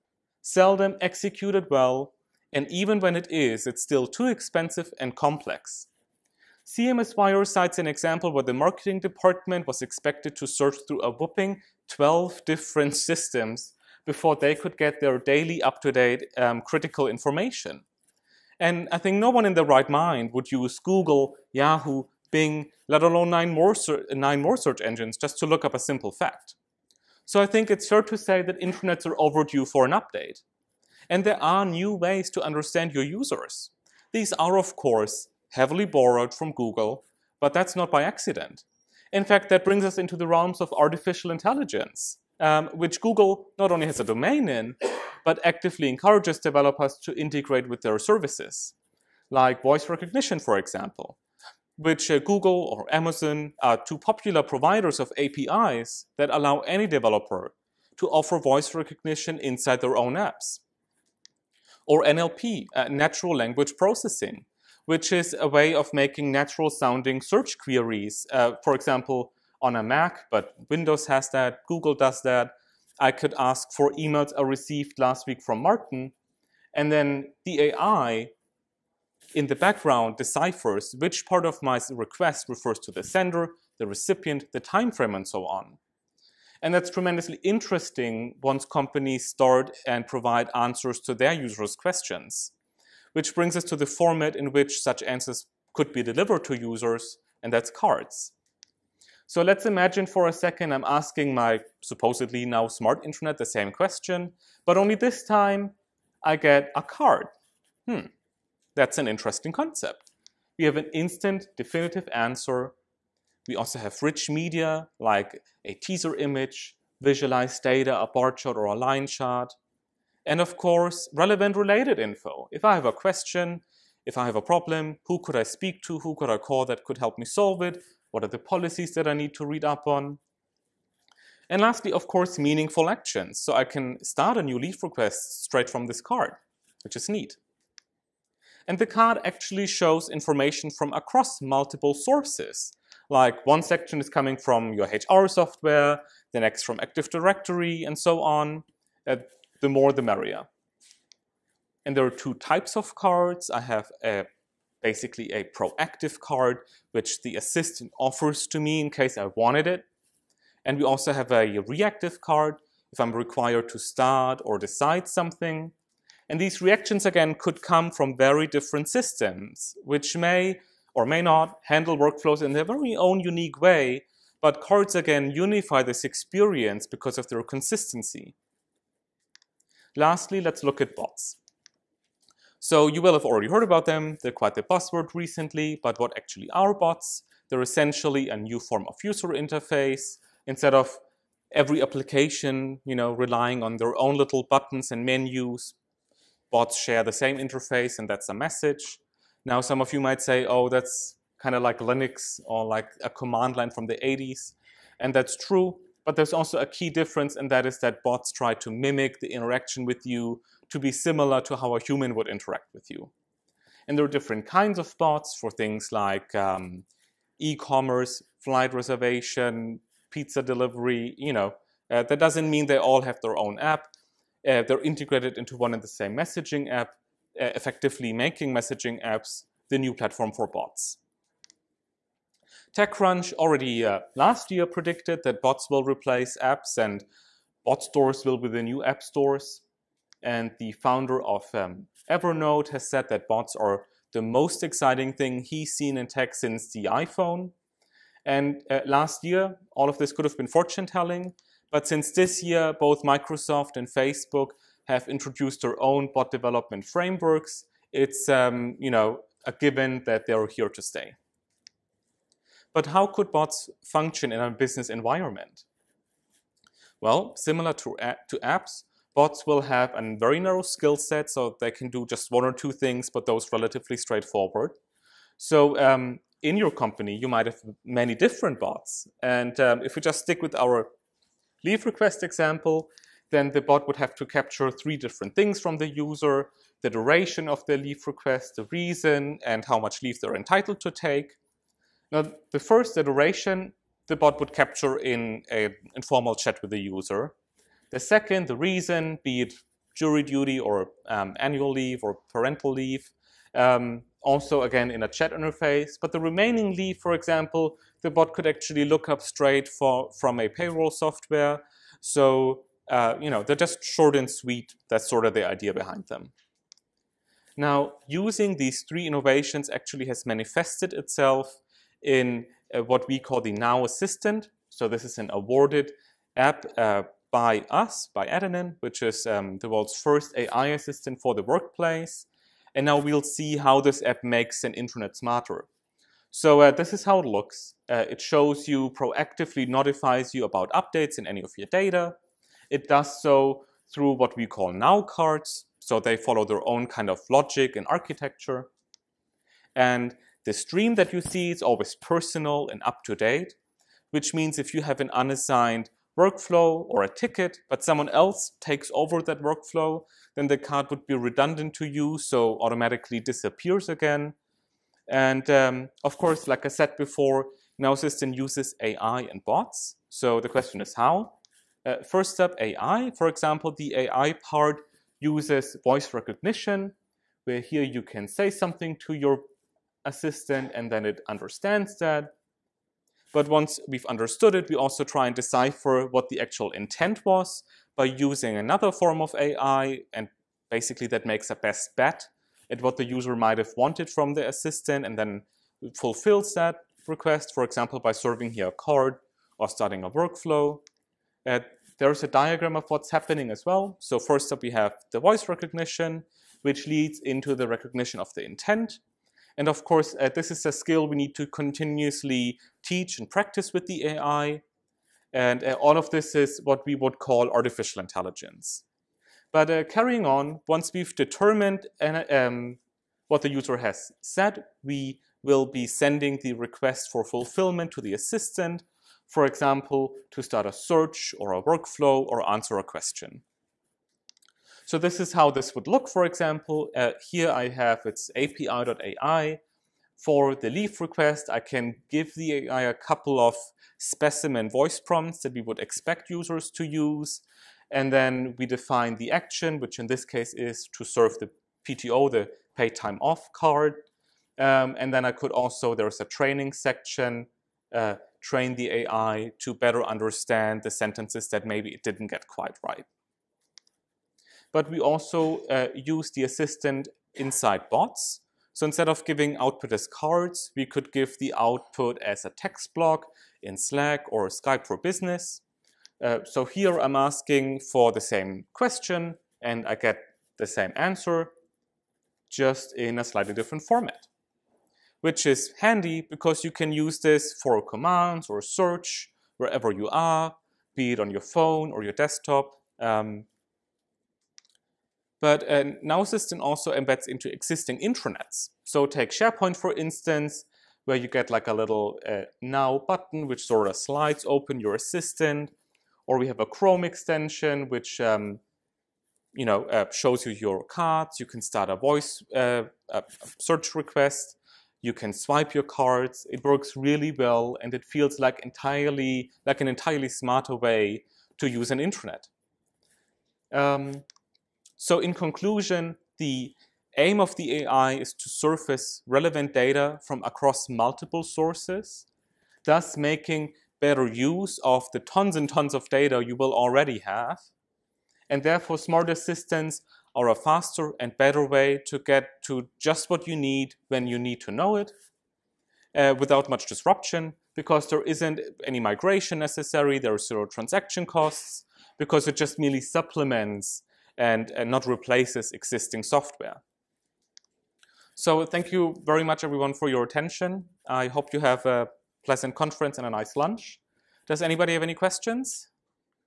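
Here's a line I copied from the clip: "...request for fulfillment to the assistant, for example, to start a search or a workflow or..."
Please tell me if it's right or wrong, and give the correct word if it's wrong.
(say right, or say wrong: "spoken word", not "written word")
right.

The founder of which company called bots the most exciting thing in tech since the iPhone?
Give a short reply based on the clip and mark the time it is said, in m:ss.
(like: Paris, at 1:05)
Evernote, at 4:02.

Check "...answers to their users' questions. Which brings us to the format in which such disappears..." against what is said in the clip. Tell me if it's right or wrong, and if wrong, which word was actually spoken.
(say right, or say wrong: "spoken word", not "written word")
wrong: "answers", not "disappears".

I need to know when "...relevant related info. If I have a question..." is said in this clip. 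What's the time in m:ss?
2:01.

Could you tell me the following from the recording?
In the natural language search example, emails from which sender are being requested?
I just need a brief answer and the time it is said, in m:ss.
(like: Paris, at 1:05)
Martin, at 1:15.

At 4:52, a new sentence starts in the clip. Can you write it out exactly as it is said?
Now, the first, the duration, the bot would capture in an informal chat with the user.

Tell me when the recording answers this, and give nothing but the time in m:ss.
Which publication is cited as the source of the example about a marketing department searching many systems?
0:06.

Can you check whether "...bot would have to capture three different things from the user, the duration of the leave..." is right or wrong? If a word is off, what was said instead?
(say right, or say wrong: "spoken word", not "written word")
right.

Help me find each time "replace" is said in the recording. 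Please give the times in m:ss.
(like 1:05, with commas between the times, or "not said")
3:55, 9:15.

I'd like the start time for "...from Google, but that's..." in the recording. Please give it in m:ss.
0:36.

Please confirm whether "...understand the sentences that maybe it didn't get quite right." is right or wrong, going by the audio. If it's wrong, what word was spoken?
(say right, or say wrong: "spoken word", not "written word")
right.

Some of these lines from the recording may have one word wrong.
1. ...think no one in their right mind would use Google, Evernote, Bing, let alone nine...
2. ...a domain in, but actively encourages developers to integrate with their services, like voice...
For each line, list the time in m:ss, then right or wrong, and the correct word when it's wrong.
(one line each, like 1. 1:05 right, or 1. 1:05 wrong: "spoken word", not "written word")
1. 0:18 wrong: "Yahoo", not "Evernote"
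2. 0:43 right.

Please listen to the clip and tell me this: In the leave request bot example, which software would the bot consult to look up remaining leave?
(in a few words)
payroll software.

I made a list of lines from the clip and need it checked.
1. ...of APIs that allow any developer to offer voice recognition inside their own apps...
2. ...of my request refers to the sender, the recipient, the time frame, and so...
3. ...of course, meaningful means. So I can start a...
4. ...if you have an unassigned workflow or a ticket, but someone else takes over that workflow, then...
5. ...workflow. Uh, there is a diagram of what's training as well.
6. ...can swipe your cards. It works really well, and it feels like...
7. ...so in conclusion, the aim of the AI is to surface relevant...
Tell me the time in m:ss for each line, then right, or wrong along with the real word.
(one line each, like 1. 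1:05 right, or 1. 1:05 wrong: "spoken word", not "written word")
1. 0:54 right
2. 1:21 right
3. 2:11 wrong: "actions", not "means"
4. 5:54 right
5. 6:40 wrong: "happening", not "training"
6. 8:35 right
7. 8:44 right.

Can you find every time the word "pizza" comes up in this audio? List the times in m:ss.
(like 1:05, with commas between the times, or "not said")
3:40.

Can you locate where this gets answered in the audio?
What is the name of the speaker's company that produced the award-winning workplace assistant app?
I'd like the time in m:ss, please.
5:28.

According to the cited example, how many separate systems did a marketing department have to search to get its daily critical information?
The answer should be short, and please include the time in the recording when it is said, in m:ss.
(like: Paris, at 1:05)
12, at 0:11.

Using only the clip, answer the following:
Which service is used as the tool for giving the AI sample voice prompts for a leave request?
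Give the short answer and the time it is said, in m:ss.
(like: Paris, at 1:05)
api.ai, at 7:18.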